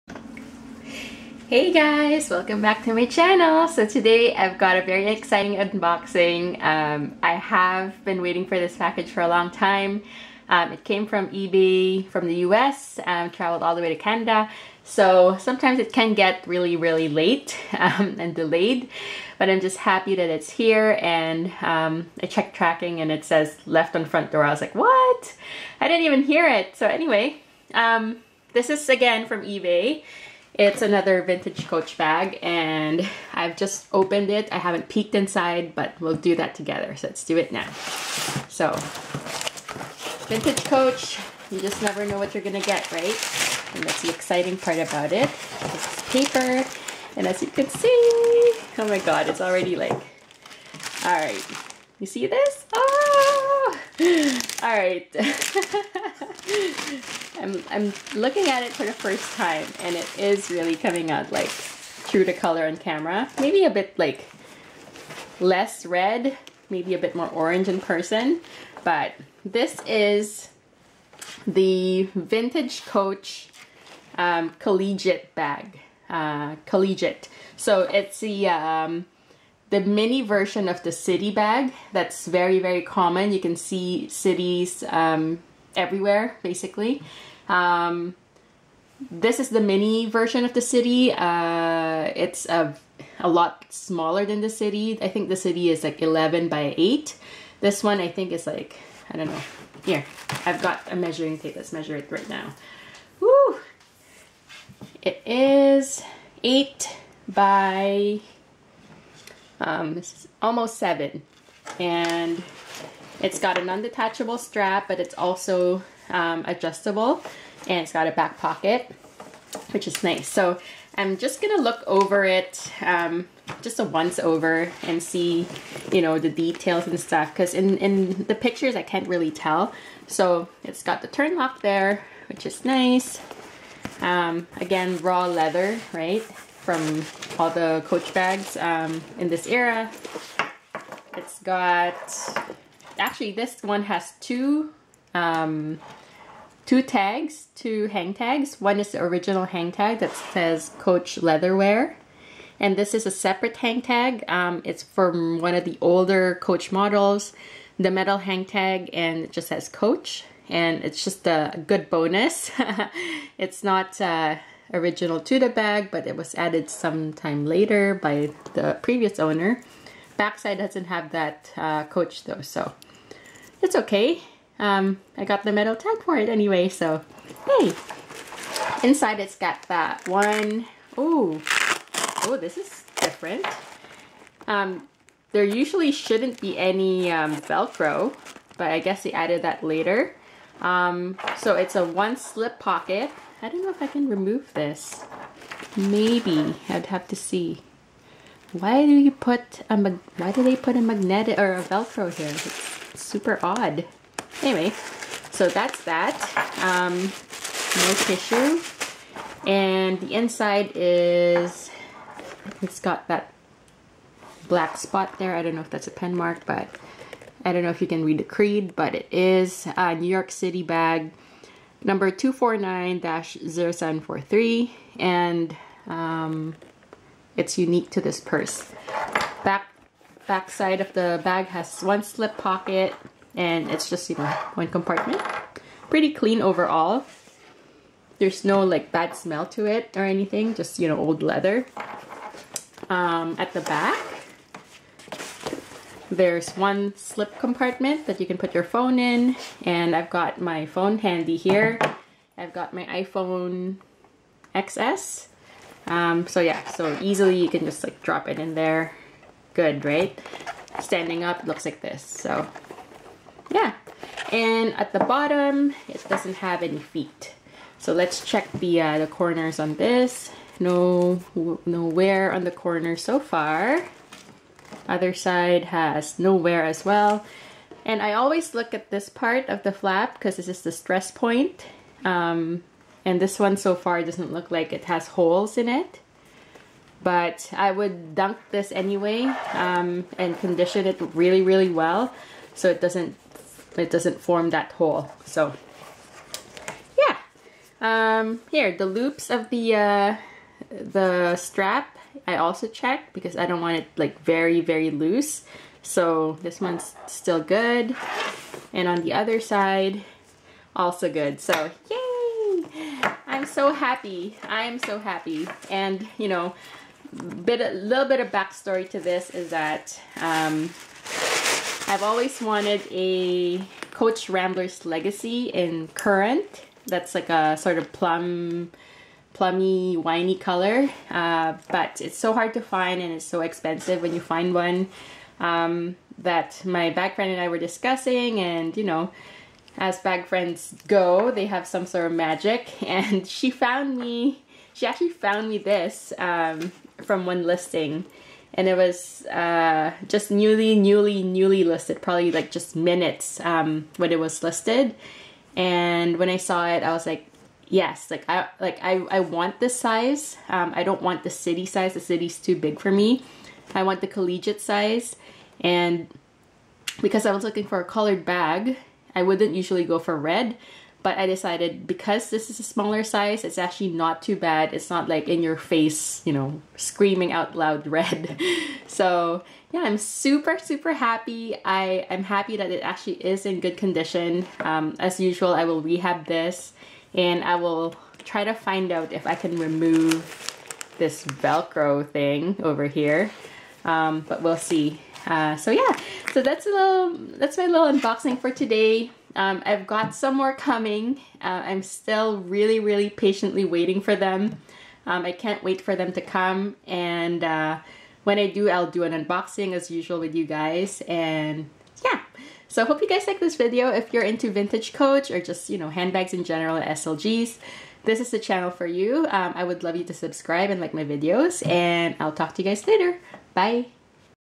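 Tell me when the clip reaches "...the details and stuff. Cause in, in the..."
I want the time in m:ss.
2:06.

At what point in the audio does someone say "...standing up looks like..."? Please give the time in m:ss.
4:20.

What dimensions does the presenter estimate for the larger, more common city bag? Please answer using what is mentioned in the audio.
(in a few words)
11 by 8.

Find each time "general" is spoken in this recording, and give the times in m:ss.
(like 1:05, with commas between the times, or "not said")
6:56.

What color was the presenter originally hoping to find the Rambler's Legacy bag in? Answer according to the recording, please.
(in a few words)
Currant.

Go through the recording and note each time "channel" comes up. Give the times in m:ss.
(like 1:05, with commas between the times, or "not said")
0:03, 6:58.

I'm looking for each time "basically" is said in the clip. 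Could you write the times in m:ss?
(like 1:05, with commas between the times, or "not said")
1:26.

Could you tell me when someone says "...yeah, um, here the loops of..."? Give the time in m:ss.
4:56.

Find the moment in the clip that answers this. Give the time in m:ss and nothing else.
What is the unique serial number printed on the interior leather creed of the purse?
3:42.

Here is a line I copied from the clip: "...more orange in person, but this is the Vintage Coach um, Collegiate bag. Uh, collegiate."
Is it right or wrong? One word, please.
right.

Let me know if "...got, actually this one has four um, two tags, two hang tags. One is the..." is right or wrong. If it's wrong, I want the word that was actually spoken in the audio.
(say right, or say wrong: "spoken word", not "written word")
wrong: "two", not "four".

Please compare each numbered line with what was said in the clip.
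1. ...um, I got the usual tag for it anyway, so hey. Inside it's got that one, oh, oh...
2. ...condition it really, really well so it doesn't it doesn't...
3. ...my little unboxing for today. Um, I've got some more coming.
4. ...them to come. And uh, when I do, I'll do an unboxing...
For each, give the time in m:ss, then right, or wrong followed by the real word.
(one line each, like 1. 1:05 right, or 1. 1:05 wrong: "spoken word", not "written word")
1. 2:54 wrong: "metal", not "usual"
2. 4:50 right
3. 6:37 right
4. 6:45 right.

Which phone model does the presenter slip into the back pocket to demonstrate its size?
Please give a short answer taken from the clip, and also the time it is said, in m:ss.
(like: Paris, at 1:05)
iPhone XS, at 4:12.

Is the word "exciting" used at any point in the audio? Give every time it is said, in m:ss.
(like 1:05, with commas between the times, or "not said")
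0:05, 0:44.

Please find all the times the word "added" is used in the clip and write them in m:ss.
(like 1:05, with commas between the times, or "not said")
2:46, 3:09.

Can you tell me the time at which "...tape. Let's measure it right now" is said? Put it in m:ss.
1:41.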